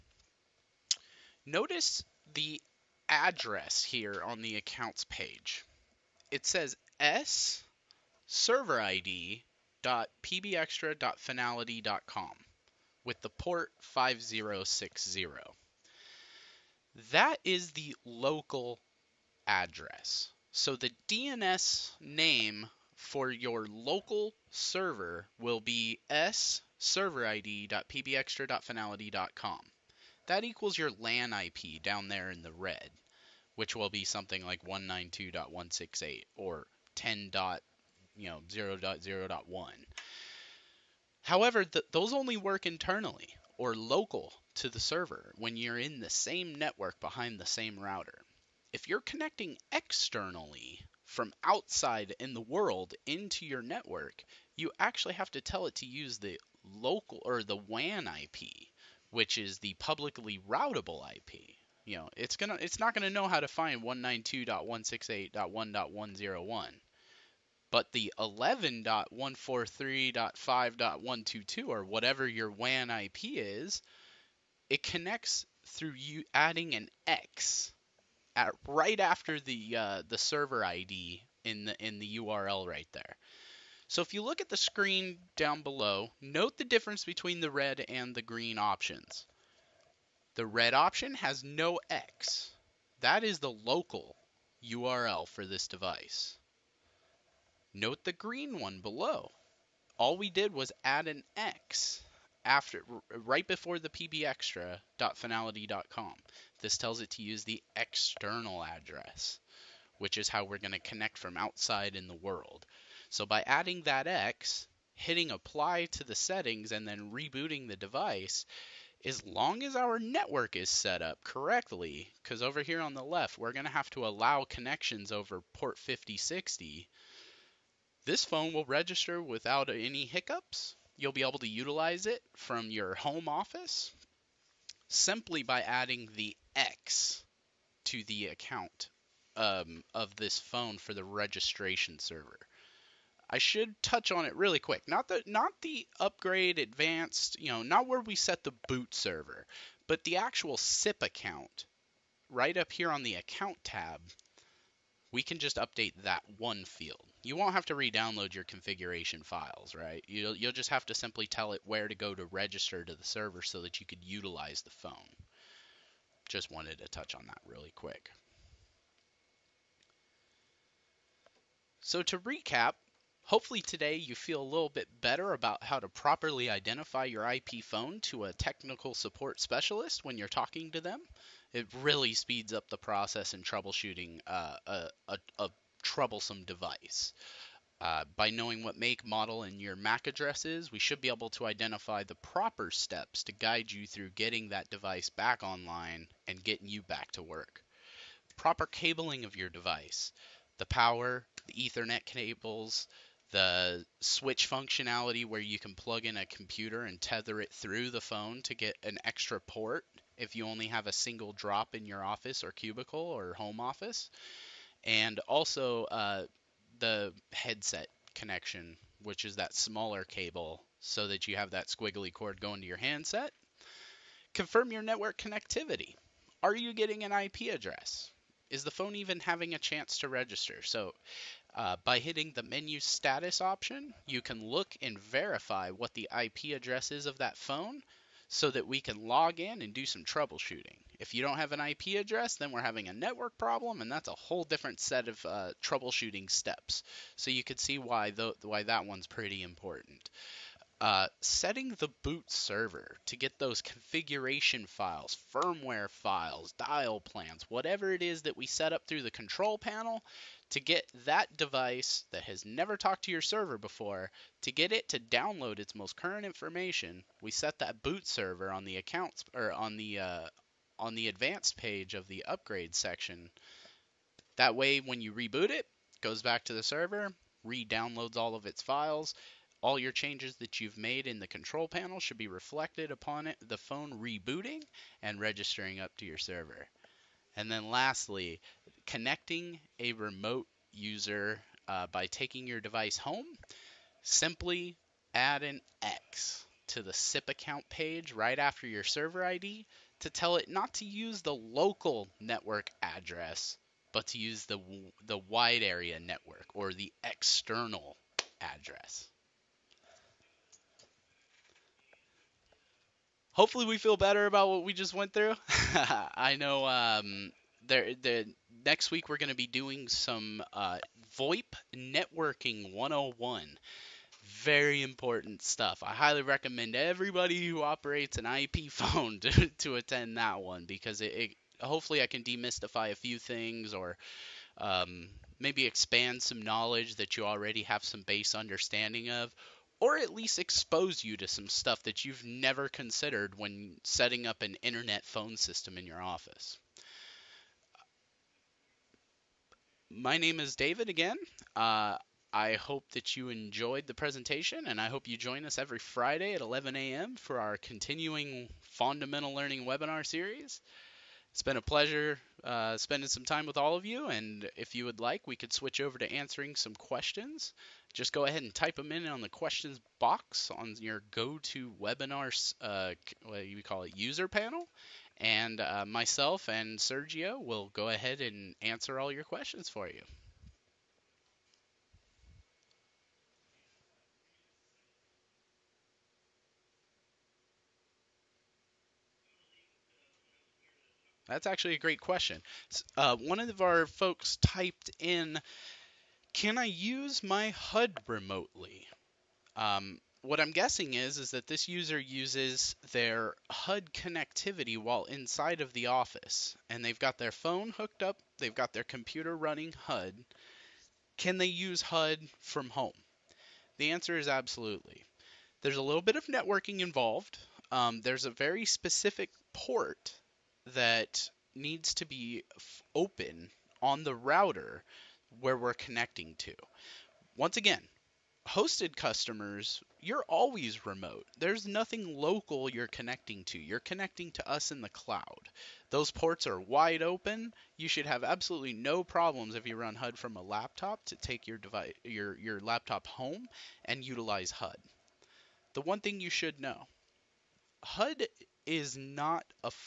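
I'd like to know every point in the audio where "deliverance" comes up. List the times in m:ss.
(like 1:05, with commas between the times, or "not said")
not said.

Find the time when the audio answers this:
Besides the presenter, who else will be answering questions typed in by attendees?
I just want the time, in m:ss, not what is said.
6:15.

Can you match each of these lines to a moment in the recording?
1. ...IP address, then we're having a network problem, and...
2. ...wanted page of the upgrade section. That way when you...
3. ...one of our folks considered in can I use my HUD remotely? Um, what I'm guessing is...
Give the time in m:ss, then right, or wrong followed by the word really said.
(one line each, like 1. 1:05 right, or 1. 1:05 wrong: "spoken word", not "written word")
1. 4:01 right
2. 4:31 wrong: "advanced", not "wanted"
3. 6:33 wrong: "typed", not "considered".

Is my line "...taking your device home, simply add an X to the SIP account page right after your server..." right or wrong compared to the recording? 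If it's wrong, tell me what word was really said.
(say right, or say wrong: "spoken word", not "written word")
right.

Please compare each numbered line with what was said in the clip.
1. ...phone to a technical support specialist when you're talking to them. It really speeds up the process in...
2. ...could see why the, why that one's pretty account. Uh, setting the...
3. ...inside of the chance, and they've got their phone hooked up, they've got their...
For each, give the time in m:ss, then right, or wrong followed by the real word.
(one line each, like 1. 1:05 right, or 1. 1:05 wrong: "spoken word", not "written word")
1. 2:57 right
2. 4:07 wrong: "important", not "account"
3. 6:45 wrong: "office", not "chance".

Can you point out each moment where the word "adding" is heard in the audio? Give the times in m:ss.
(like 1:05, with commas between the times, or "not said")
1:16, 1:53, 2:15.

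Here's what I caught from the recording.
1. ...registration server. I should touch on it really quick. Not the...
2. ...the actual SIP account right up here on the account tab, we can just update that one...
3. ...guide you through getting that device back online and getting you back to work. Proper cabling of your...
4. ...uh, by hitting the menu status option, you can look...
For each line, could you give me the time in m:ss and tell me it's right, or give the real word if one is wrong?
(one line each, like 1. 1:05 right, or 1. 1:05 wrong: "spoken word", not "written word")
1. 2:21 right
2. 2:30 right
3. 3:13 right
4. 3:51 right.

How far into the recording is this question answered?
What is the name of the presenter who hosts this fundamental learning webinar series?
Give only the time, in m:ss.
5:49.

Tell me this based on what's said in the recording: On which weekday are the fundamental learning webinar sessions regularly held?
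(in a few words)
Friday.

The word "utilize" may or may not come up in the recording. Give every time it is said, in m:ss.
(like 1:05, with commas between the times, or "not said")
2:11, 2:44, 7:24.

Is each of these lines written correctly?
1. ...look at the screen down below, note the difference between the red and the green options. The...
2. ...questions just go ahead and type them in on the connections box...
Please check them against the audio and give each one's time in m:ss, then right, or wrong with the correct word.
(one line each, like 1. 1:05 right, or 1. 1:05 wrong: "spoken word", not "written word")
1. 1:24 right
2. 6:06 wrong: "questions", not "connections".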